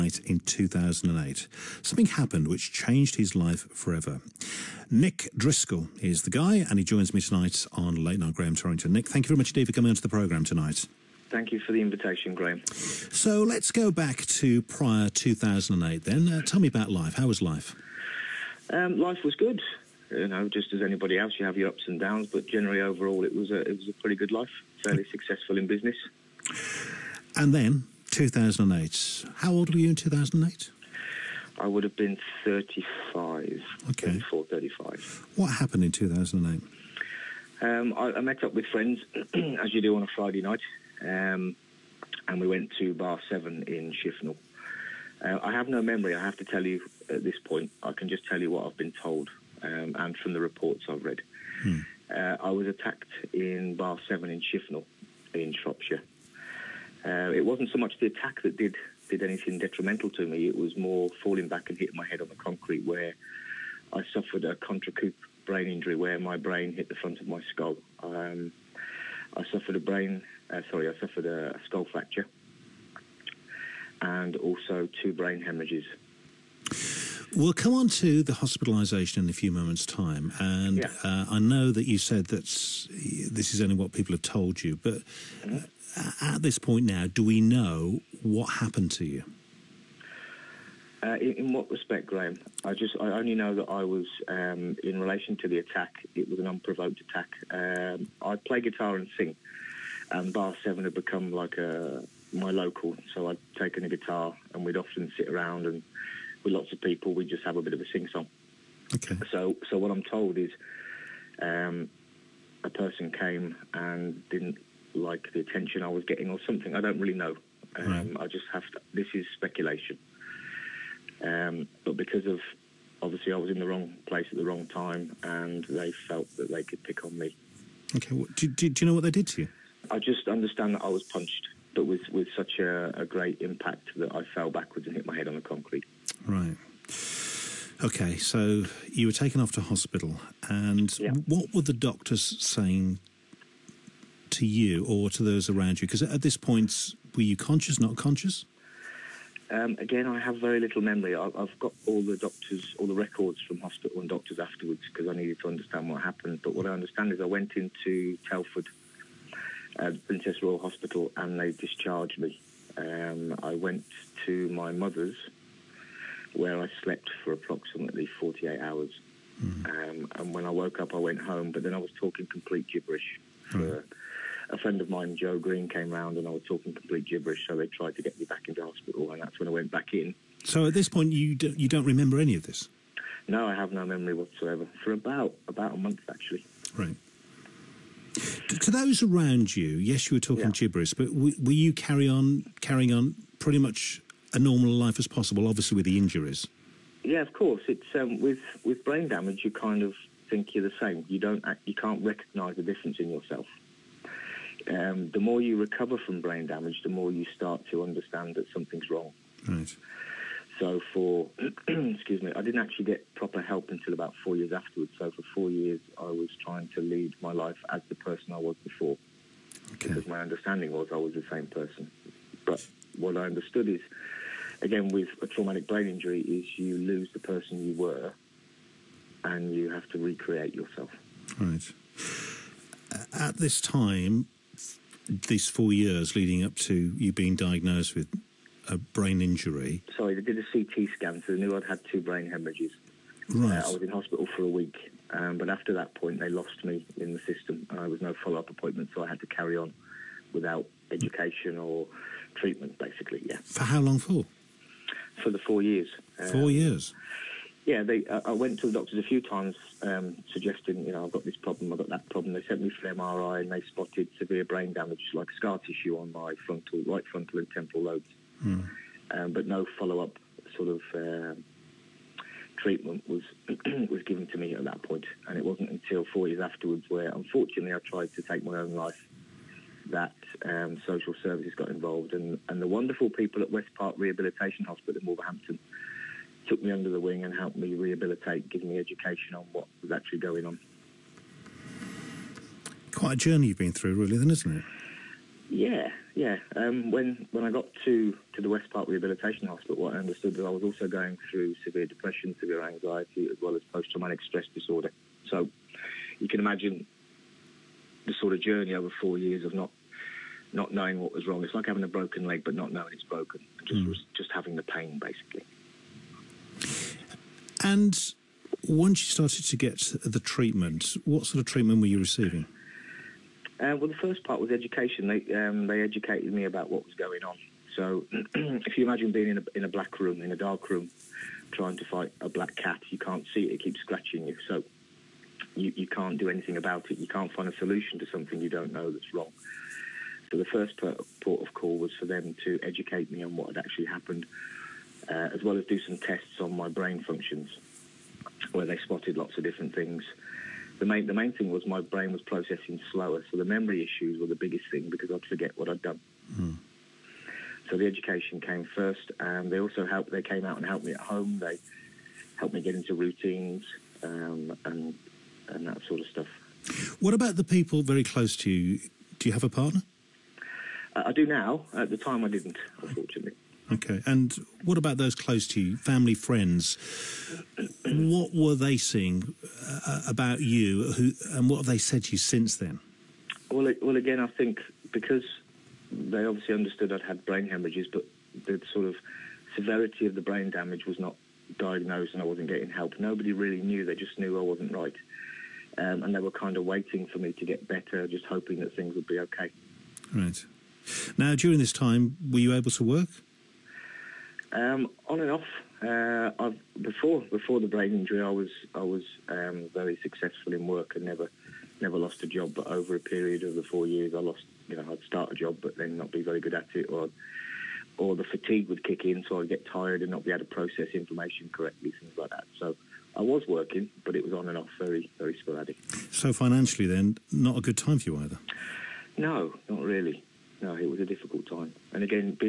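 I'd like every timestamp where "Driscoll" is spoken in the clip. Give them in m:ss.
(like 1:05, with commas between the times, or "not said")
0:05.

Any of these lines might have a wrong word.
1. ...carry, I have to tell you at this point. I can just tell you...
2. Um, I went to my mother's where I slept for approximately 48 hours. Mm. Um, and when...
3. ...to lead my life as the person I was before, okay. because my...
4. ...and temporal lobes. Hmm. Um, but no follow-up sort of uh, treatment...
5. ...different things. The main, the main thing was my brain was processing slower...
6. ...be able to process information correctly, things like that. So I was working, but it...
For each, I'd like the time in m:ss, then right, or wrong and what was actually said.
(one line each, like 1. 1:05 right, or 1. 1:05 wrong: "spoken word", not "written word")
1. 0:45 wrong: "memory", not "carry"
2. 2:42 right
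3. 3:36 right
4. 4:27 right
5. 5:49 right
6. 7:00 right.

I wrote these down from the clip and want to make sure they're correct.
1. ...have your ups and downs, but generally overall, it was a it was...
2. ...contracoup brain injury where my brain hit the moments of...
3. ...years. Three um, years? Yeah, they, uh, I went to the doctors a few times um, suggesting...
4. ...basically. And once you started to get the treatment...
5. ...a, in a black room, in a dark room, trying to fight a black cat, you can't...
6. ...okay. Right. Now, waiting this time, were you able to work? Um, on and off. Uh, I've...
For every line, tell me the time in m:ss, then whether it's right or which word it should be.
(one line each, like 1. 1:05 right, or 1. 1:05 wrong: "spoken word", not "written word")
1. 0:21 right
2. 1:04 wrong: "front", not "moments"
3. 4:15 wrong: "Four", not "Three"
4. 5:14 right
5. 5:29 right
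6. 6:39 wrong: "during", not "waiting".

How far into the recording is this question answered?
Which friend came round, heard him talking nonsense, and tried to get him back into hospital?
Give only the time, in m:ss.
2:55.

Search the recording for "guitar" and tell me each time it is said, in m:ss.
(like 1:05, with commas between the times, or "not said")
1:38, 1:43.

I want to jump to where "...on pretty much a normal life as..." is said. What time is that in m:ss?
3:12.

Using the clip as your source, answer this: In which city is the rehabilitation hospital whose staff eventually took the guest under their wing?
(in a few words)
Wolverhampton.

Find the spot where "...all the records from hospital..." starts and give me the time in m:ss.
2:32.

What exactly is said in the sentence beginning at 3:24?
Um, the more you recover from brain damage, the more you start to understand that something's wrong.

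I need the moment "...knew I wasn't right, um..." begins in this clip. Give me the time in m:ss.
6:34.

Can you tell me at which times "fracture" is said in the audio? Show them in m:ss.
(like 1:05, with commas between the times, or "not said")
1:11.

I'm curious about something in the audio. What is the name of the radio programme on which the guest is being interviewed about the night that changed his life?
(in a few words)
Late Night Graham Torrington.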